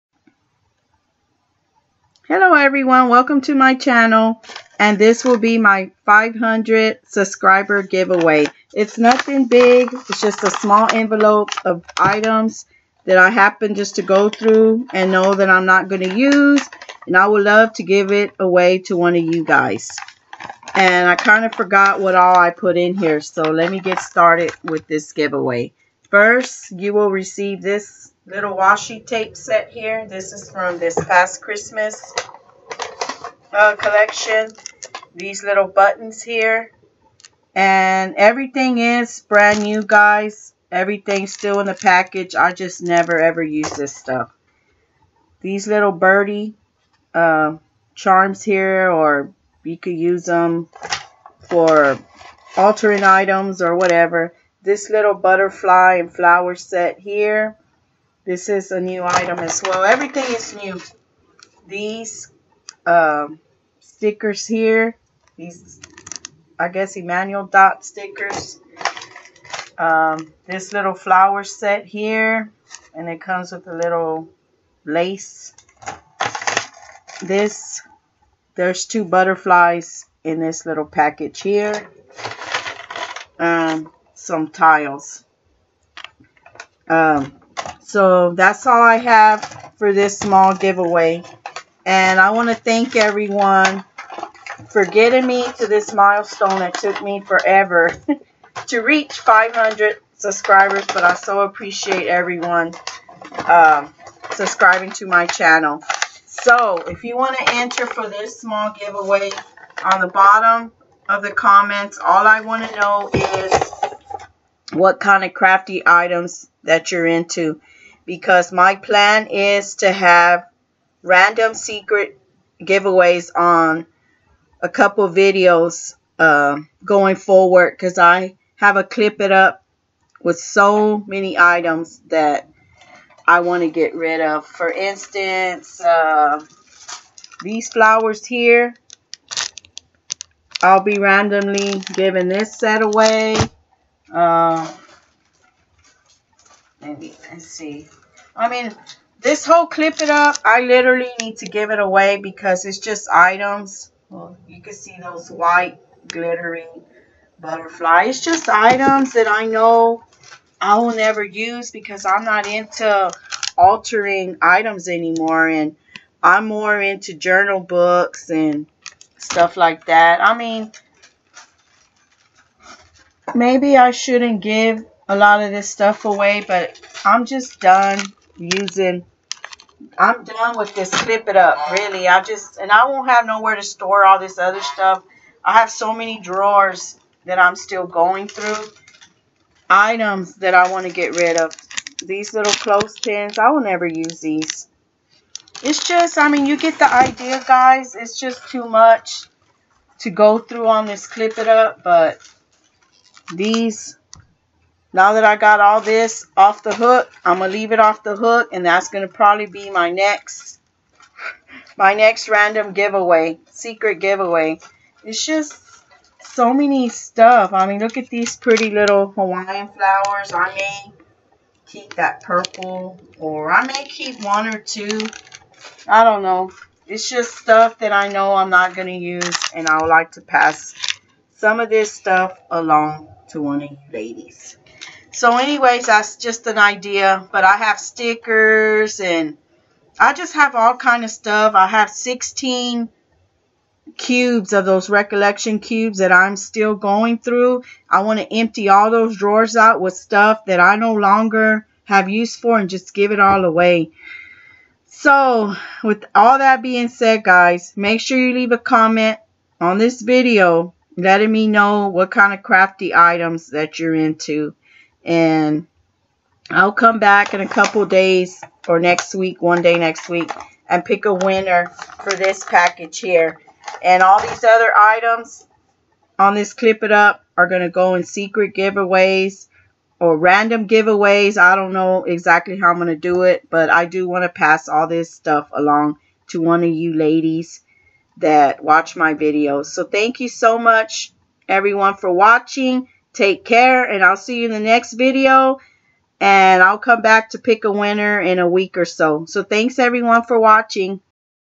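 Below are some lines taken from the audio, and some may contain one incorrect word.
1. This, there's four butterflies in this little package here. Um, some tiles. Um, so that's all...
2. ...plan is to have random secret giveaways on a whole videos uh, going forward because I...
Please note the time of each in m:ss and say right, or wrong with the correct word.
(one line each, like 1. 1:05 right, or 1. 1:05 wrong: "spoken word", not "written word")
1. 1:17 wrong: "two", not "four"
2. 1:58 wrong: "couple", not "whole".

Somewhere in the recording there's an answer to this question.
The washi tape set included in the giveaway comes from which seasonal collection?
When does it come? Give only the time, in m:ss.
0:30.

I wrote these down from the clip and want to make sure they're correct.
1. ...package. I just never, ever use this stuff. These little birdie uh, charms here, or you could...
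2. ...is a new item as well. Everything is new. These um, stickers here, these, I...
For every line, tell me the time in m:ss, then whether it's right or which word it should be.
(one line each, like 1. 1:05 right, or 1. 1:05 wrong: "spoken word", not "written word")
1. 0:41 right
2. 0:58 right.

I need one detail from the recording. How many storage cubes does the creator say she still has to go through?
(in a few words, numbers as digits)
16.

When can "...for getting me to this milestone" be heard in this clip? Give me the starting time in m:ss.
1:34.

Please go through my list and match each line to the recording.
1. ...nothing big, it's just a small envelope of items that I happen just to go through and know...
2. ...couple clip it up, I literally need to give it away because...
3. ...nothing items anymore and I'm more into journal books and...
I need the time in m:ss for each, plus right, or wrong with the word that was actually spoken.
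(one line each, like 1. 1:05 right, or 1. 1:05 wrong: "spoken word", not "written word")
1. 0:08 right
2. 2:29 wrong: "whole", not "couple"
3. 2:43 wrong: "altering", not "nothing".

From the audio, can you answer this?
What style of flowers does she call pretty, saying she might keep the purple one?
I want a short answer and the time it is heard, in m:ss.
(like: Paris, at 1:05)
Hawaiian, at 3:39.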